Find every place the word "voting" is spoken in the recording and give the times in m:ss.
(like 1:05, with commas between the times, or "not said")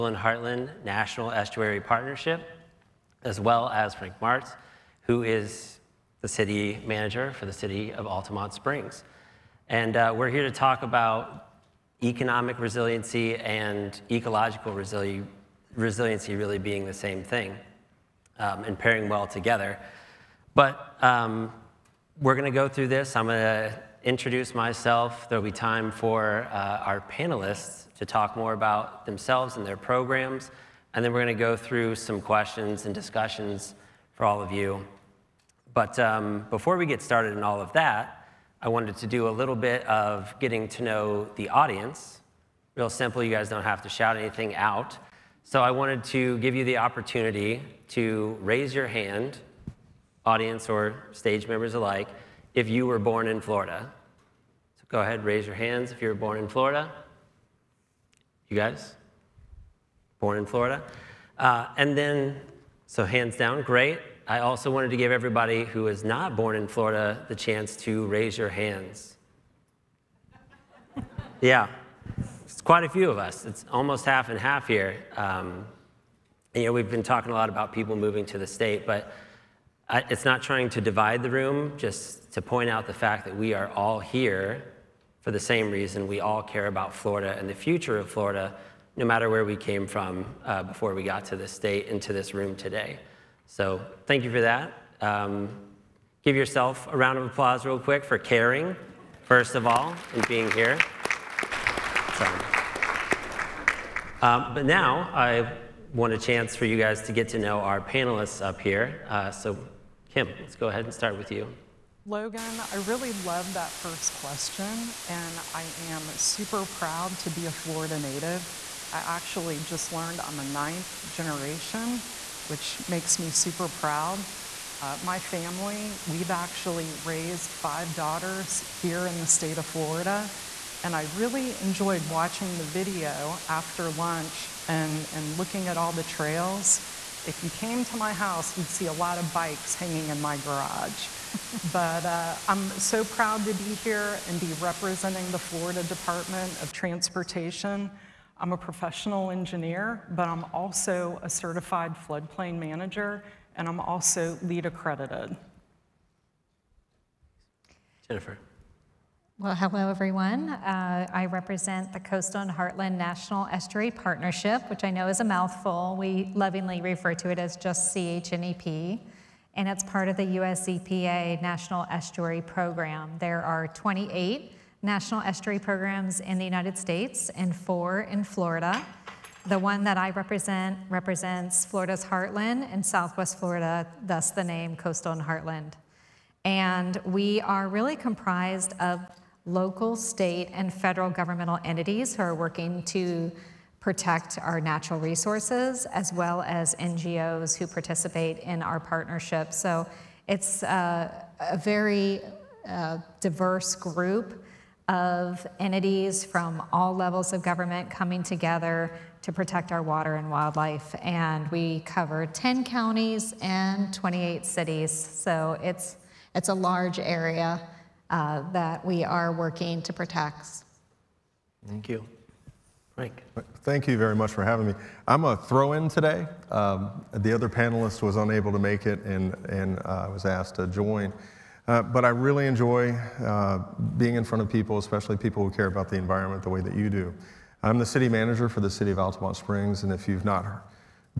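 not said.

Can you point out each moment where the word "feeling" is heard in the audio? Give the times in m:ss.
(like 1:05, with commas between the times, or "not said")
not said.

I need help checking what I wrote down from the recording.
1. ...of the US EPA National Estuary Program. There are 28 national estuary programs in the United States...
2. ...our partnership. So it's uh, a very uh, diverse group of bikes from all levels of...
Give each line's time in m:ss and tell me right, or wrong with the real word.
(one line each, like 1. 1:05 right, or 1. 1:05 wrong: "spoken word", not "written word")
1. 2:50 right
2. 3:18 wrong: "entities", not "bikes".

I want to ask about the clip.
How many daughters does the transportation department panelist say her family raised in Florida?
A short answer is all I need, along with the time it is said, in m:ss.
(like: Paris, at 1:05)
5, at 2:07.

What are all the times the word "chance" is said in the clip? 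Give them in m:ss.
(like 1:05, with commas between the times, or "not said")
1:07, 1:46.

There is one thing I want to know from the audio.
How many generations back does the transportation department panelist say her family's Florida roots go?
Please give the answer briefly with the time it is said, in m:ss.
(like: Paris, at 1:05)
9th generation, at 2:00.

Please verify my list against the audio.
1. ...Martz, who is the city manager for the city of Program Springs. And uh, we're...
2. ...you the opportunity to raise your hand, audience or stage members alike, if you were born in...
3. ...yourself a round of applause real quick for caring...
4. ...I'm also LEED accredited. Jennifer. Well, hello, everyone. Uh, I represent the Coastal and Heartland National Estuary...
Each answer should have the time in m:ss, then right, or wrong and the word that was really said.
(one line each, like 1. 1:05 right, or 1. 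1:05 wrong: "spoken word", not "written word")
1. 0:04 wrong: "Altamonte", not "Program"
2. 0:46 right
3. 1:36 right
4. 2:33 right.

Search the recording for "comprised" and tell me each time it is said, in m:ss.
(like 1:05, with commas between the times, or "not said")
3:07.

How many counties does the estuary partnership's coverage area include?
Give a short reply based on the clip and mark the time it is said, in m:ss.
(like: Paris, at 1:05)
10, at 3:32.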